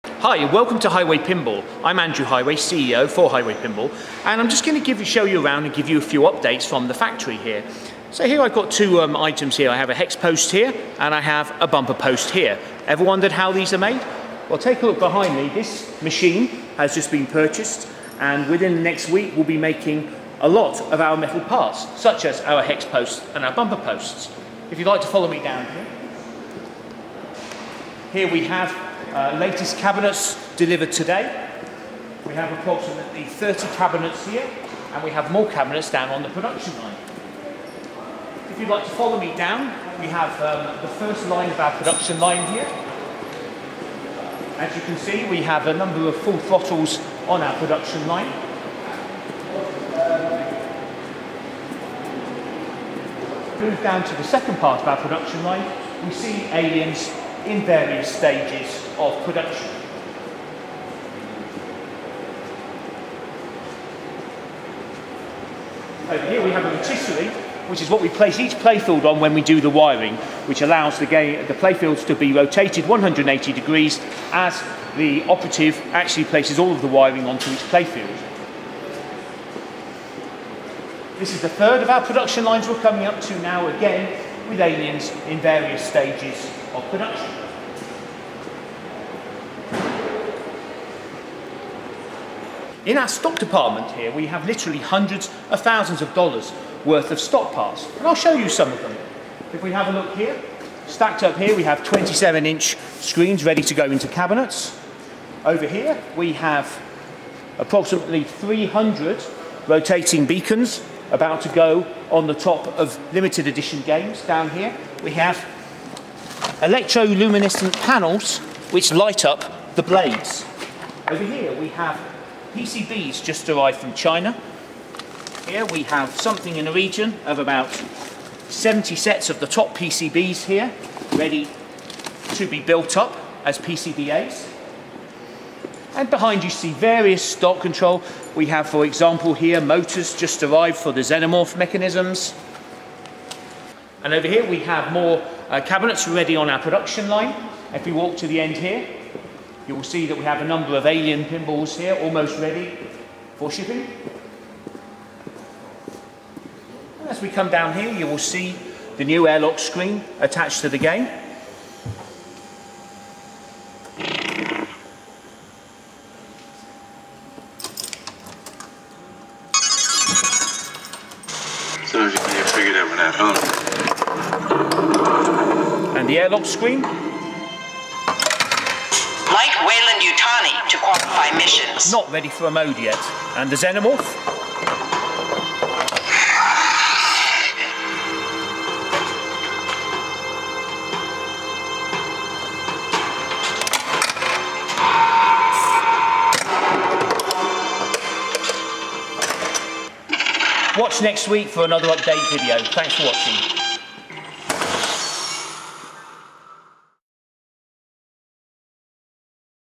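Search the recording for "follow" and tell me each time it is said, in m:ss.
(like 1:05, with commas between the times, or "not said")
0:25, 0:38.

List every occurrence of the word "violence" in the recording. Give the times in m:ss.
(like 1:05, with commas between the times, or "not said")
not said.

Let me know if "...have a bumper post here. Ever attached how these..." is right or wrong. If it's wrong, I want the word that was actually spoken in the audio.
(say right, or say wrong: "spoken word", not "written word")
wrong: "wondered", not "attached".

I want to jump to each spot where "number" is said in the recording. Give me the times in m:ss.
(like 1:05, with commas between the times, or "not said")
0:45, 2:30.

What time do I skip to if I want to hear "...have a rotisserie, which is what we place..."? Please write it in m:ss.
1:06.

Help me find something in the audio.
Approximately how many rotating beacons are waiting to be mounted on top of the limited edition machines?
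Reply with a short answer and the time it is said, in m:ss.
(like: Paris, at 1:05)
300, at 1:48.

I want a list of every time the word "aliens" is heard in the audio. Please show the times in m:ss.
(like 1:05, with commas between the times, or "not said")
0:56, 1:24, 2:30.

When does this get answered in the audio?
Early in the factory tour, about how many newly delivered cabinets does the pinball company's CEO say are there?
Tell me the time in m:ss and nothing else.
0:33.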